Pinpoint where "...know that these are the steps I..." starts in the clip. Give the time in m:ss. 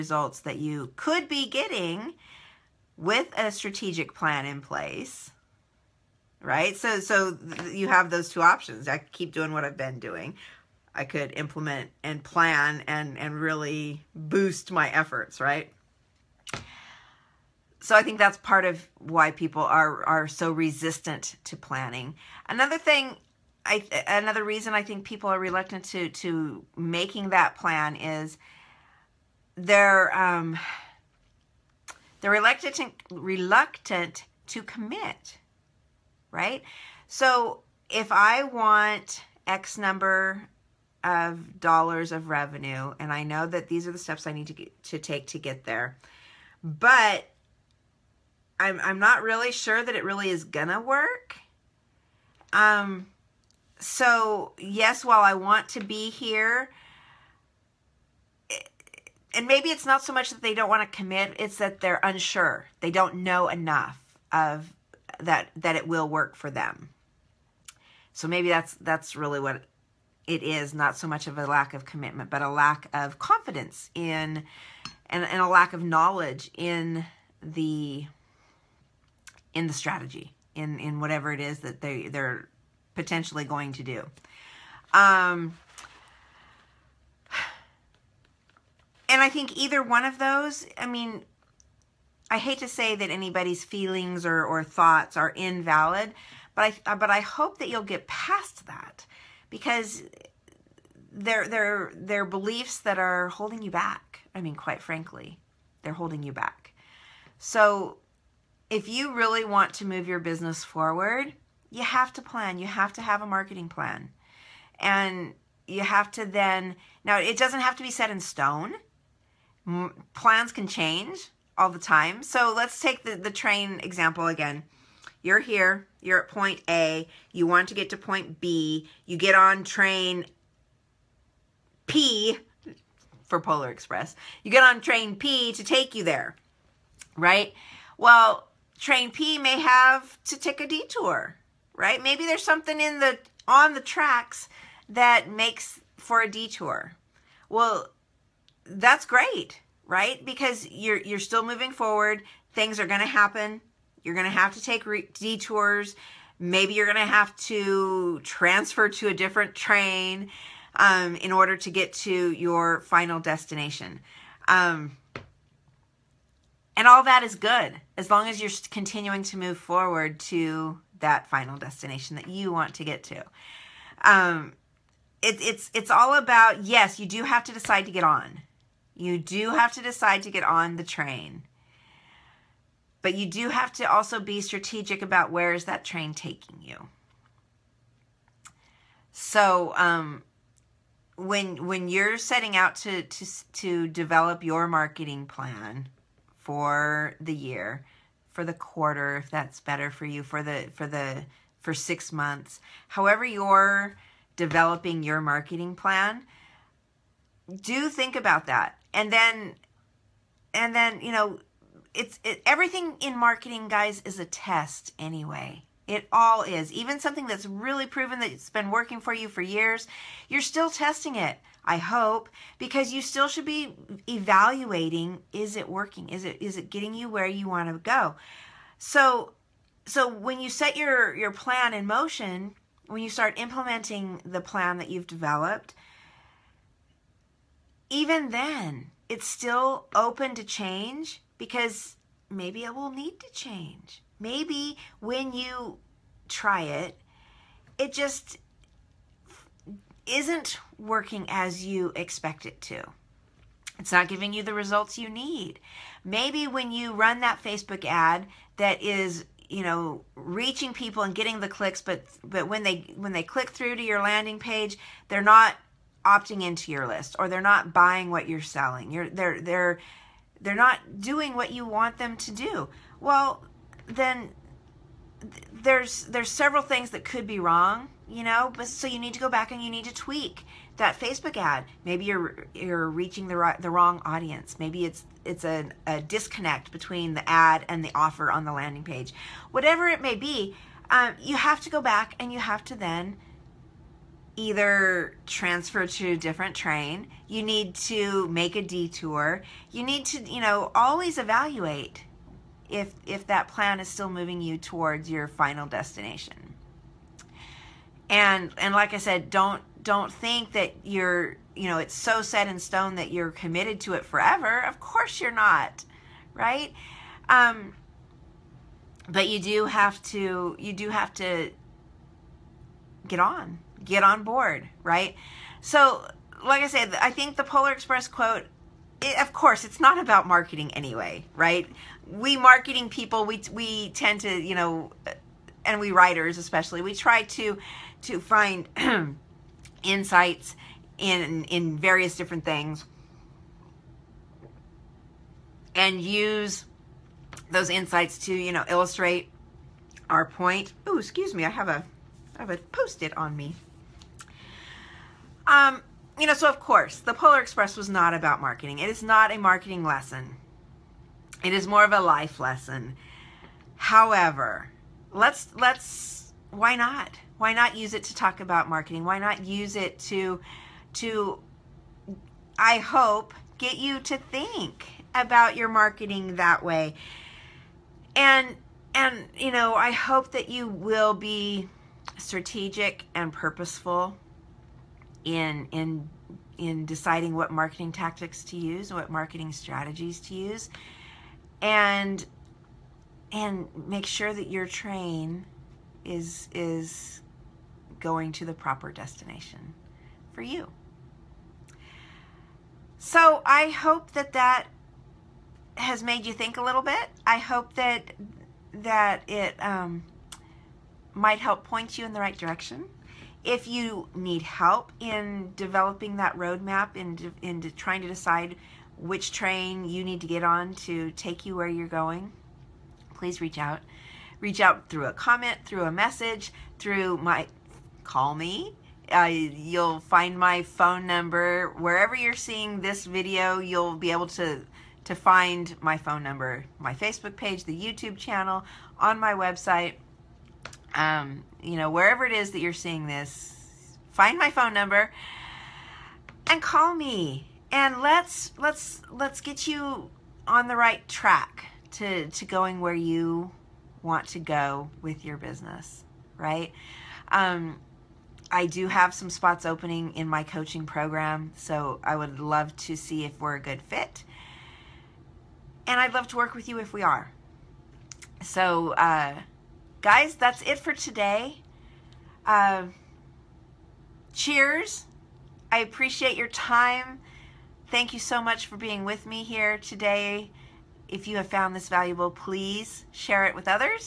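0:43.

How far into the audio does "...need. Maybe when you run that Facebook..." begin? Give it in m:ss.
4:15.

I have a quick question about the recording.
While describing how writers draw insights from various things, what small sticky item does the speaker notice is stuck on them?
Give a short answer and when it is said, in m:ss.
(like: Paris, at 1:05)
post-it, at 5:52.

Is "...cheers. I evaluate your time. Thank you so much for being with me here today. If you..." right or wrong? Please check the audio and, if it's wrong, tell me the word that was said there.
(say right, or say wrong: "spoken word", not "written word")
wrong: "appreciate", not "evaluate".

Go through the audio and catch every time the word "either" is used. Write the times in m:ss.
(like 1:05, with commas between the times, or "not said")
1:29, 4:54.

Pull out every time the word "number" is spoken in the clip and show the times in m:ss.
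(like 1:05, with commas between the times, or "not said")
0:39, 7:11, 7:16, 7:24.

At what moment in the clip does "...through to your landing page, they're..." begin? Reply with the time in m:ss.
4:23.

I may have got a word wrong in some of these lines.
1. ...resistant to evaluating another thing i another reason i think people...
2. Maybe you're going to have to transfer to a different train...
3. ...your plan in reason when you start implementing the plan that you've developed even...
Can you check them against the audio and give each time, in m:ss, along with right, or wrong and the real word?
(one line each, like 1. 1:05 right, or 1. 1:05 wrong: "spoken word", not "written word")
1. 0:20 wrong: "planning", not "evaluating"
2. 2:36 right
3. 3:51 wrong: "motion", not "reason".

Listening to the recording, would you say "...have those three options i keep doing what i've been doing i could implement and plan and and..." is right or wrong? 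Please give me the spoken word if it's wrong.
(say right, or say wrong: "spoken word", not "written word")
wrong: "two", not "three".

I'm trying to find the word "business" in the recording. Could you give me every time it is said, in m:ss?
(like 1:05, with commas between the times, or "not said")
1:50, 7:35.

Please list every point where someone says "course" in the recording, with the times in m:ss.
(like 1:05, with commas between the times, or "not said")
5:14, 5:29, 5:56.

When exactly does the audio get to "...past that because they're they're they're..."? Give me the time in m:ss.
1:38.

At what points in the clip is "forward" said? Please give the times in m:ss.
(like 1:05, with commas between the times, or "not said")
1:50, 2:31, 2:49.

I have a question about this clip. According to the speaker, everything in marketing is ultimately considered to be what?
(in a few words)
a test.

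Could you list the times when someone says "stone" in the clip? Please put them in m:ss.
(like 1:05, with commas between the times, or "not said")
1:58, 5:12.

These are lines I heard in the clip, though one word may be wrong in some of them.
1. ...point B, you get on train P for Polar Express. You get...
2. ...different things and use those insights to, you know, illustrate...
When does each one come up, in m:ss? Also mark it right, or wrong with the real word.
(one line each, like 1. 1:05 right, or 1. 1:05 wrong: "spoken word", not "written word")
1. 2:07 right
2. 5:42 right.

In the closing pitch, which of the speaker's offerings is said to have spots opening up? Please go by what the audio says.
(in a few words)
coaching program.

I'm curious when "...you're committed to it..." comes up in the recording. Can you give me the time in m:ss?
5:13.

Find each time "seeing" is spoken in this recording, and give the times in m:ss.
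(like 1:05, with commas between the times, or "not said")
7:12, 7:22.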